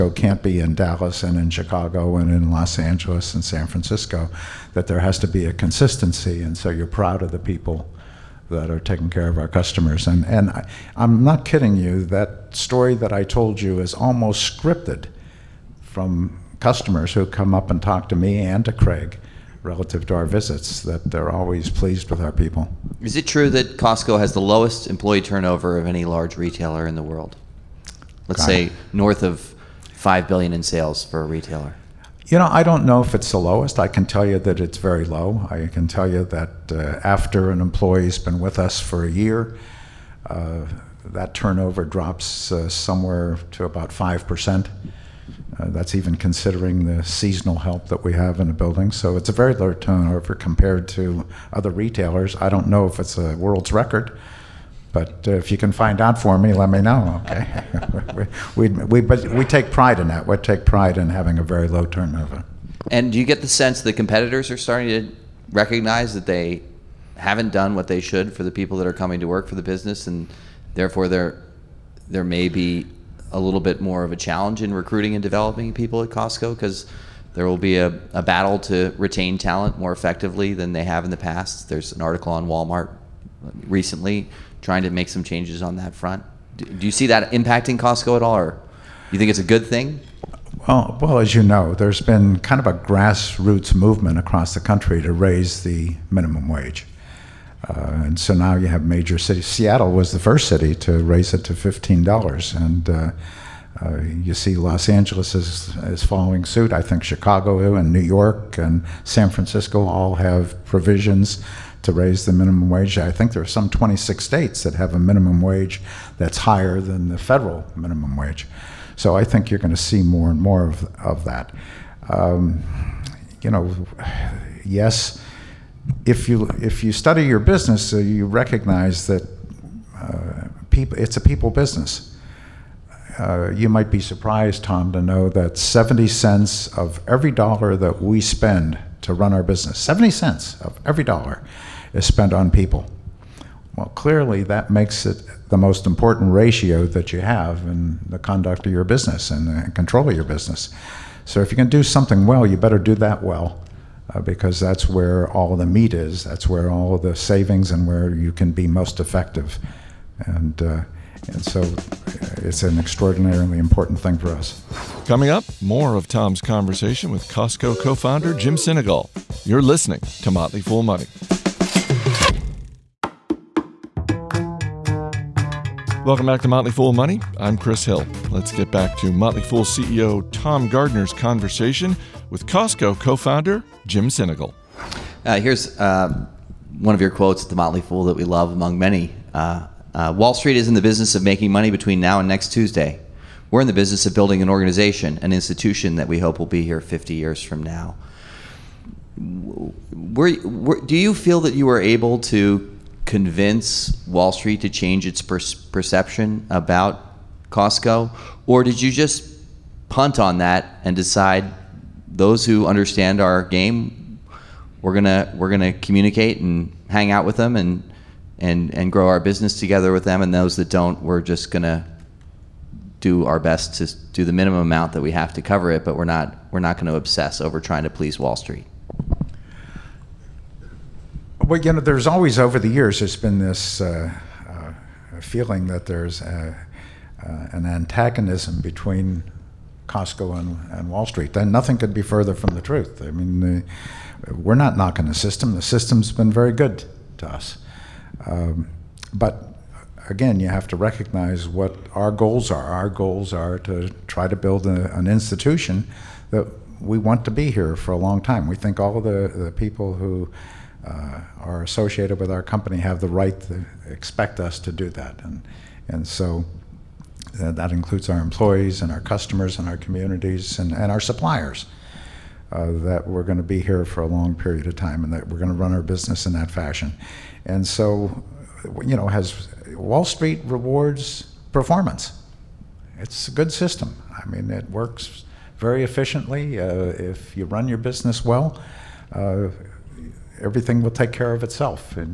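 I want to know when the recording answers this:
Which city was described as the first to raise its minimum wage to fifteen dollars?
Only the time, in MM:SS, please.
01:39.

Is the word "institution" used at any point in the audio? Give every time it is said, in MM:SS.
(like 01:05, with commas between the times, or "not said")
03:15, 04:15.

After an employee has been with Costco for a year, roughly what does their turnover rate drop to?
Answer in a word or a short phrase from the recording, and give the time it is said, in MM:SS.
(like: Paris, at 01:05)
5%, at 00:43.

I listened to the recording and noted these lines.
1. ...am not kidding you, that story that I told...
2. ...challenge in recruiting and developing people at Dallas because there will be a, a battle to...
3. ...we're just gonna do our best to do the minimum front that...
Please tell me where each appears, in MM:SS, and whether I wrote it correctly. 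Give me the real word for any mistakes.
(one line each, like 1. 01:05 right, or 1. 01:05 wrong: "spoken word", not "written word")
1. 00:10 right
2. 01:14 wrong: "Costco", not "Dallas"
3. 03:41 wrong: "amount", not "front".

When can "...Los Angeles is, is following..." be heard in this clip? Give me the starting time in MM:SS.
01:44.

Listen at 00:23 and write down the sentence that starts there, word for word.
Is it true that Costco has the lowest employee turnover of any large retailer in the world?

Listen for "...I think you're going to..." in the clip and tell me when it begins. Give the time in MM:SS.
01:59.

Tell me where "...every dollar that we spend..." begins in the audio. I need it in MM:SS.
02:17.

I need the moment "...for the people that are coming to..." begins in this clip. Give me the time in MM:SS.
01:08.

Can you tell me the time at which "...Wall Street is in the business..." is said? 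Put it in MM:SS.
03:10.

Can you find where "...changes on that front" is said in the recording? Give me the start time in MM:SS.
01:25.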